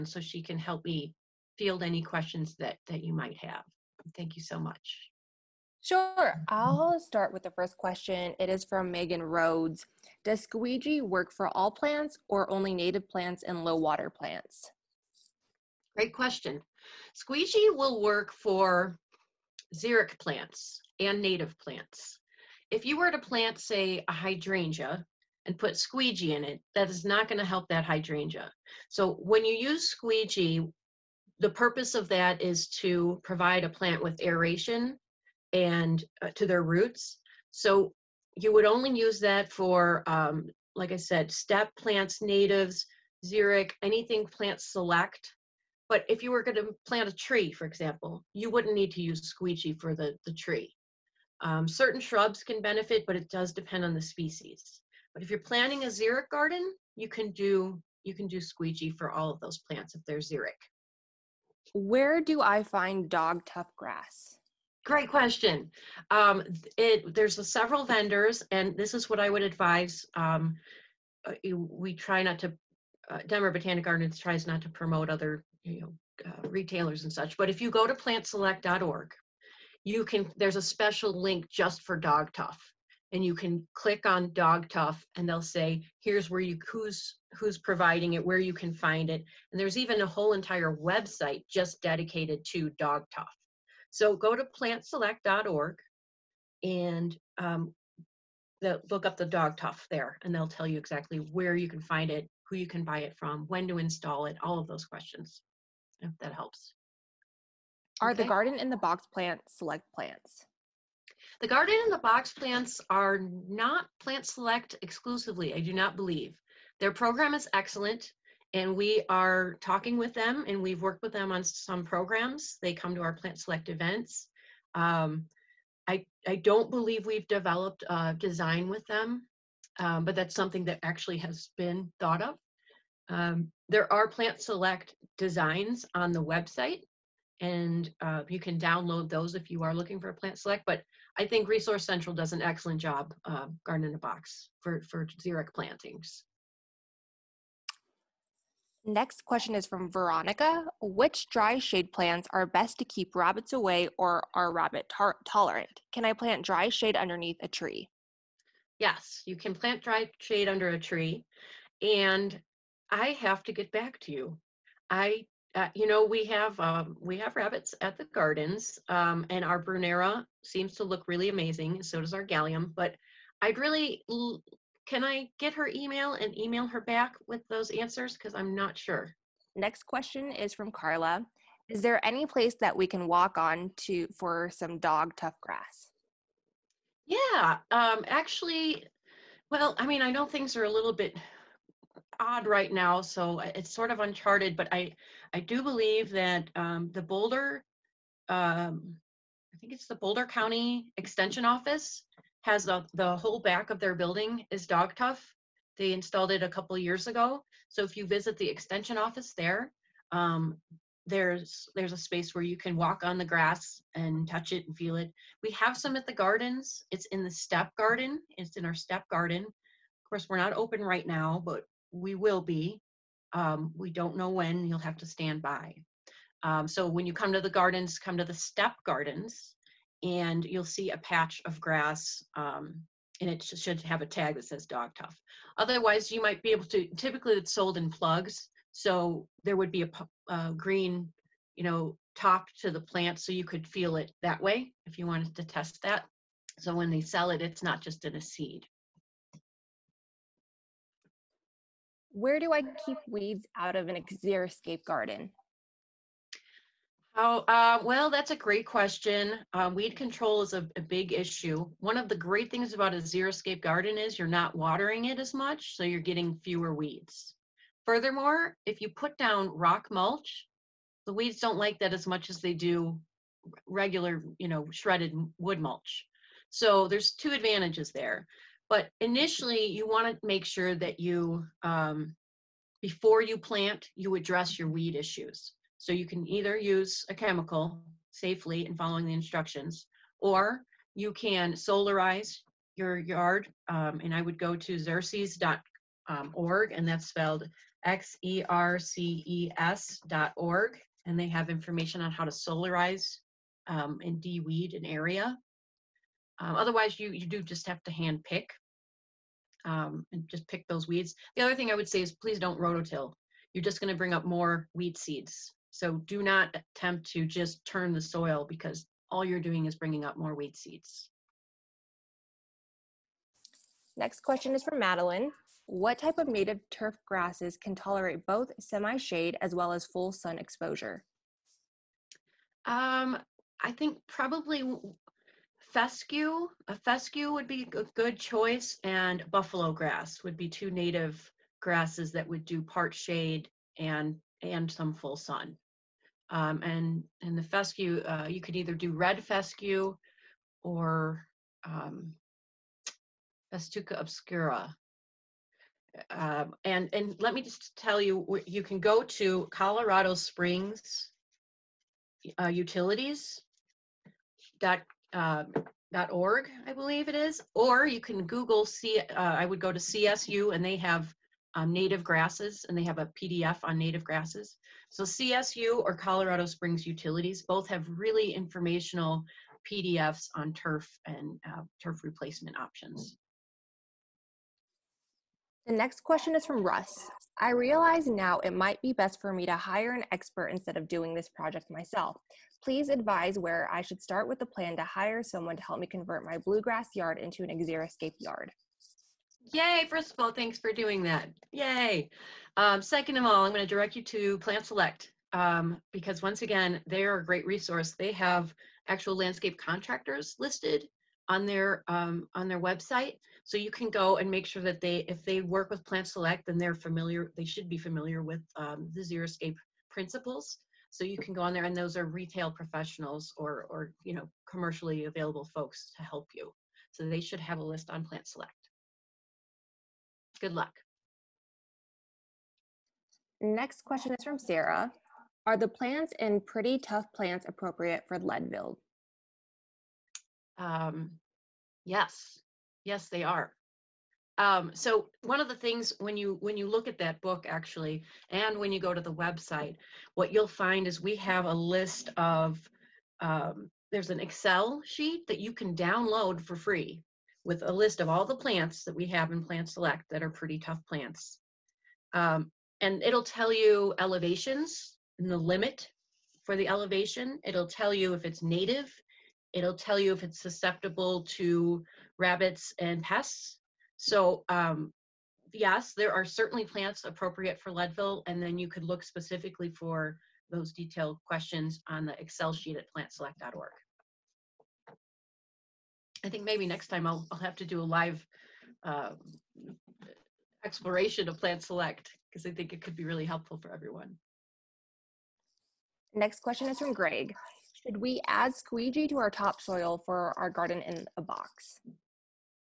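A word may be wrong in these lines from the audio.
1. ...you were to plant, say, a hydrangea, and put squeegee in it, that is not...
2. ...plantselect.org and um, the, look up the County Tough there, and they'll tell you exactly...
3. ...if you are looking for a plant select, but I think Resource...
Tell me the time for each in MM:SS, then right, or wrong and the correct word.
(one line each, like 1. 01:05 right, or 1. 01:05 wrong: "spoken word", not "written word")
1. 00:22 right
2. 01:34 wrong: "Dog", not "County"
3. 02:19 right.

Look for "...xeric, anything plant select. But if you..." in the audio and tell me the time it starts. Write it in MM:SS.
00:43.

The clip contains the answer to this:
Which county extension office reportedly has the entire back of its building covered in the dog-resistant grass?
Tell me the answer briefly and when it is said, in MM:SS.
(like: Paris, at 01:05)
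Boulder County, at 03:19.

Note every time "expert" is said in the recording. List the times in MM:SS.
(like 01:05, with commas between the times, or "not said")
06:30.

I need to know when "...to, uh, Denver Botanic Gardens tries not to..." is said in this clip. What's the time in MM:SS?
01:12.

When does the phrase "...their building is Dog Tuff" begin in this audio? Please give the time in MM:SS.
03:23.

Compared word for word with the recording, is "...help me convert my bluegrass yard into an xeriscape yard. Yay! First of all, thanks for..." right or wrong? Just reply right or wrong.
right.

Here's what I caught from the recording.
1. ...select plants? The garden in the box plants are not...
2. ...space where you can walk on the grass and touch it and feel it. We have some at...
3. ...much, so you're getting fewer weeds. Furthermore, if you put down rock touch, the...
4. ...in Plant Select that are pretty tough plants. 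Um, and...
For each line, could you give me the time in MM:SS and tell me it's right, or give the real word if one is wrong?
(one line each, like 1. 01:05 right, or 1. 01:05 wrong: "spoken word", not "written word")
1. 01:49 right
2. 03:31 right
3. 04:25 wrong: "mulch", not "touch"
4. 07:39 right.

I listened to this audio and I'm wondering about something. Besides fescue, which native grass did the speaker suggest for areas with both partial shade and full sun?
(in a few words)
Buffalo grass.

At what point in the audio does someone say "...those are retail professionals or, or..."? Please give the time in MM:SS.
07:01.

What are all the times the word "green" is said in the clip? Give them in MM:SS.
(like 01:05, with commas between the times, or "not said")
04:00.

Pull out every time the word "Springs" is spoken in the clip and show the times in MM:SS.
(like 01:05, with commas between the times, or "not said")
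06:00, 06:16.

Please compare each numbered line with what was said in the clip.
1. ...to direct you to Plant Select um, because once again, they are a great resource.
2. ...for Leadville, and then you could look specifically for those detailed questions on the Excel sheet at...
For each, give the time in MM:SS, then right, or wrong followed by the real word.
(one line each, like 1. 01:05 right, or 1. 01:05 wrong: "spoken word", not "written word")
1. 06:43 right
2. 07:57 right.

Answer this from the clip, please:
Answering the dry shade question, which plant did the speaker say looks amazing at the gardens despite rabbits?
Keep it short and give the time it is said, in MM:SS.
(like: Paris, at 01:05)
Brunnera, at 02:49.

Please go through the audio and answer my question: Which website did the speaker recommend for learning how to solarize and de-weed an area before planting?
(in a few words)
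xerces.org.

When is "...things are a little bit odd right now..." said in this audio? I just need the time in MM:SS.
03:10.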